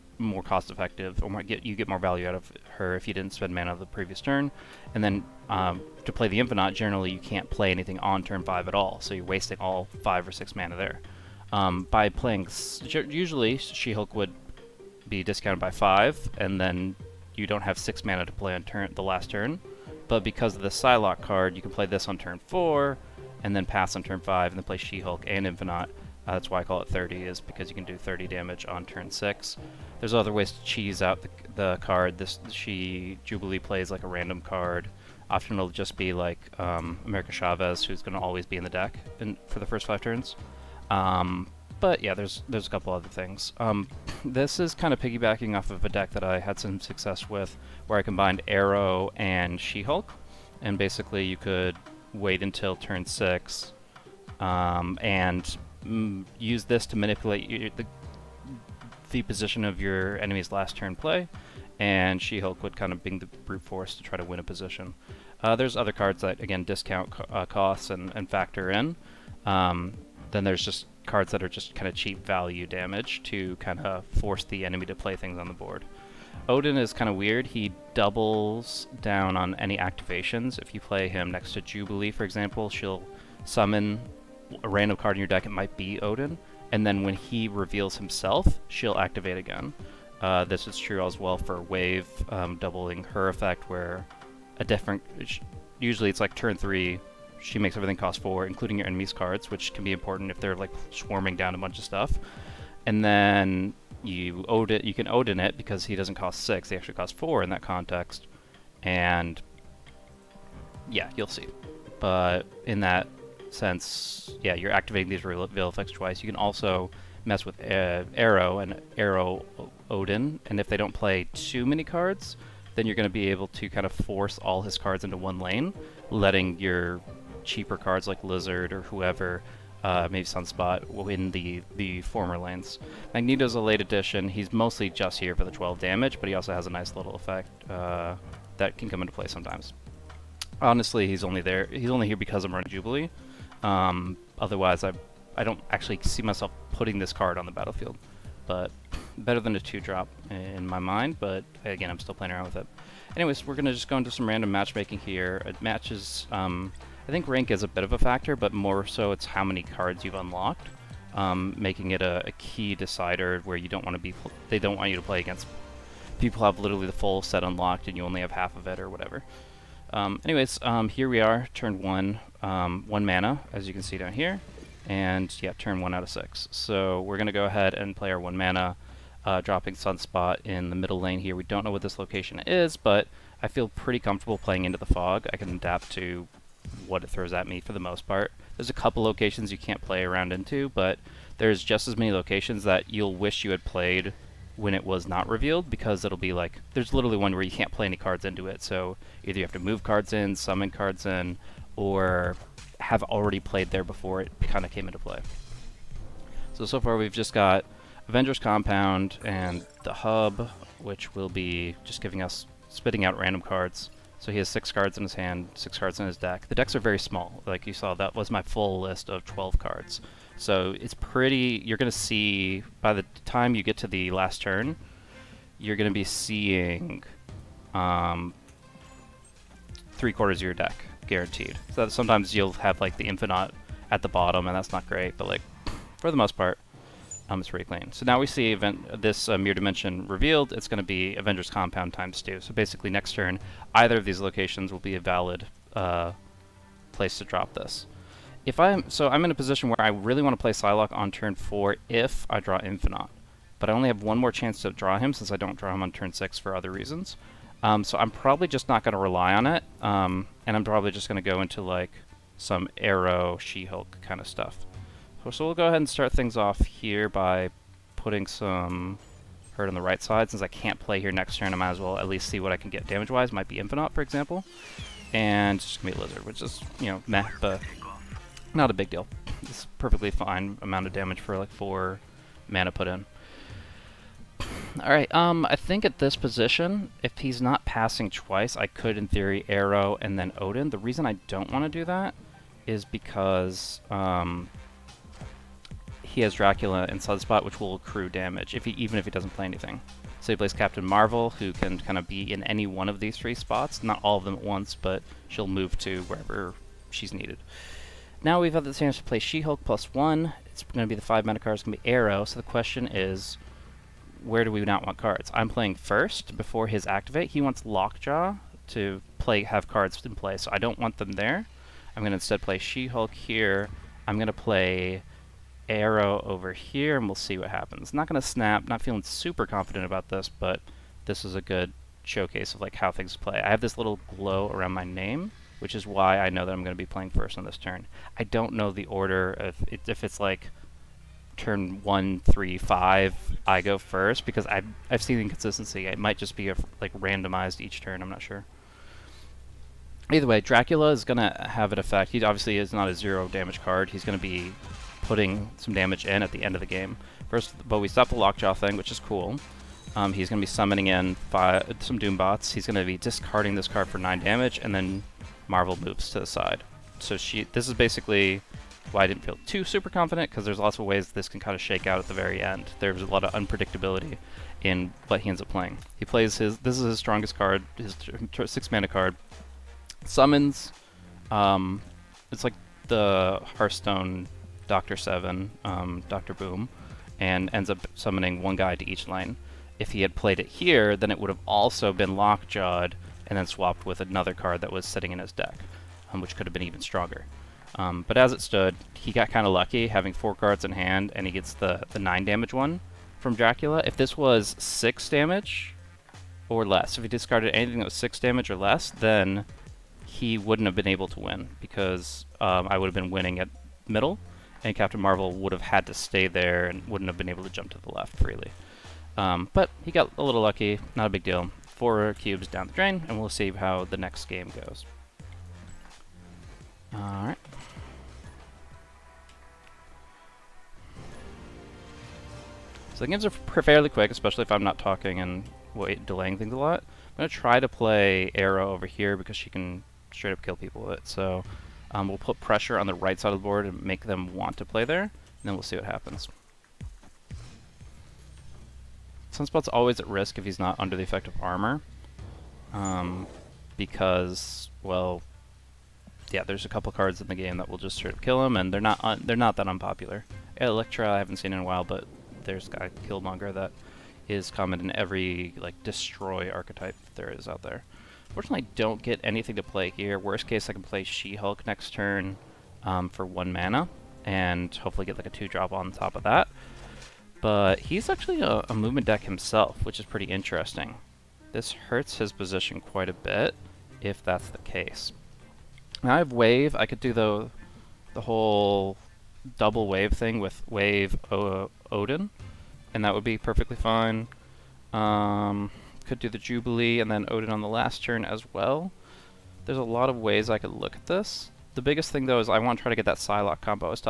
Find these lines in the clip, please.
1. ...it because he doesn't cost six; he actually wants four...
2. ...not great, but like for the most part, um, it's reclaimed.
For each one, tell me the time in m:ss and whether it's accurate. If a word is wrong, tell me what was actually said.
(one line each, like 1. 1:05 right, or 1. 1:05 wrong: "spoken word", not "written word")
1. 1:45 wrong: "costs", not "wants"
2. 3:54 right.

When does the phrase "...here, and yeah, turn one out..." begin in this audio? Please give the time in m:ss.
2:54.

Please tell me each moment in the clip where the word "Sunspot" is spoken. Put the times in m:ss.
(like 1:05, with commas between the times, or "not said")
2:10, 2:59, 4:57, 7:29.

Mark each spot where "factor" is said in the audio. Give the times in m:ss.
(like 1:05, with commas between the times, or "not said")
1:08, 2:37.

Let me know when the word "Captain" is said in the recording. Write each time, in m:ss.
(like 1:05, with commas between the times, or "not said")
5:00, 6:54.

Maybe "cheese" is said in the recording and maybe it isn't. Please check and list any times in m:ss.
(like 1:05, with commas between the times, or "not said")
0:30.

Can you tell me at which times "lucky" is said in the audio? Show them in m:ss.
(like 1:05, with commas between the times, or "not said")
6:39, 7:00.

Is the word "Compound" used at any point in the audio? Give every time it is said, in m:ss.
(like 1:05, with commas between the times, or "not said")
3:28, 4:01.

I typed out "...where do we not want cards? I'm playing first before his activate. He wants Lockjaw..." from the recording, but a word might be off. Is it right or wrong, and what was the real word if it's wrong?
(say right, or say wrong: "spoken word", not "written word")
right.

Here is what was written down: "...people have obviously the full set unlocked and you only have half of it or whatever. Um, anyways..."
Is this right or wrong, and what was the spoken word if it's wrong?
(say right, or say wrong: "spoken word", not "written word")
wrong: "literally", not "obviously".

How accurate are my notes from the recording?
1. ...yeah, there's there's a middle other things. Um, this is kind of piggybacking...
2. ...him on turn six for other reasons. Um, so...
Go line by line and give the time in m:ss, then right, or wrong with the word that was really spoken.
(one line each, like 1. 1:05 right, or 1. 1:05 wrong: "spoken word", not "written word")
1. 0:42 wrong: "couple", not "middle"
2. 4:15 right.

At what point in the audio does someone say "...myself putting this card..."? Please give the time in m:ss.
2:26.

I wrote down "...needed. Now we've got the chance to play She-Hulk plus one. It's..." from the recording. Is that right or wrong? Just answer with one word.
right.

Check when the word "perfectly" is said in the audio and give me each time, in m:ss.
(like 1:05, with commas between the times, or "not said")
4:39, 8:13.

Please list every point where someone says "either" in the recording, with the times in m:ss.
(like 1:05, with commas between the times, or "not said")
3:19, 4:03, 5:50.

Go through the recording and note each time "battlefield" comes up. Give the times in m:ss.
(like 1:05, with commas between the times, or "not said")
2:27.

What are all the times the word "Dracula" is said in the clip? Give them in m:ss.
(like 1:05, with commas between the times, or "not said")
4:56, 5:50, 6:43.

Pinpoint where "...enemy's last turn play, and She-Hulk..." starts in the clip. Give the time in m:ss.
1:00.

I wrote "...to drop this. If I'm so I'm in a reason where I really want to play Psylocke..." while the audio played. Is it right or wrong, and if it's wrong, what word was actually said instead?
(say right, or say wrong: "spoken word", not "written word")
wrong: "position", not "reason".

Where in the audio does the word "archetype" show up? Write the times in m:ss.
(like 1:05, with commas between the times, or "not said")
7:46.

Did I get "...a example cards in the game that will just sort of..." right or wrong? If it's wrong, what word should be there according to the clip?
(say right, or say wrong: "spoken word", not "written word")
wrong: "couple", not "example".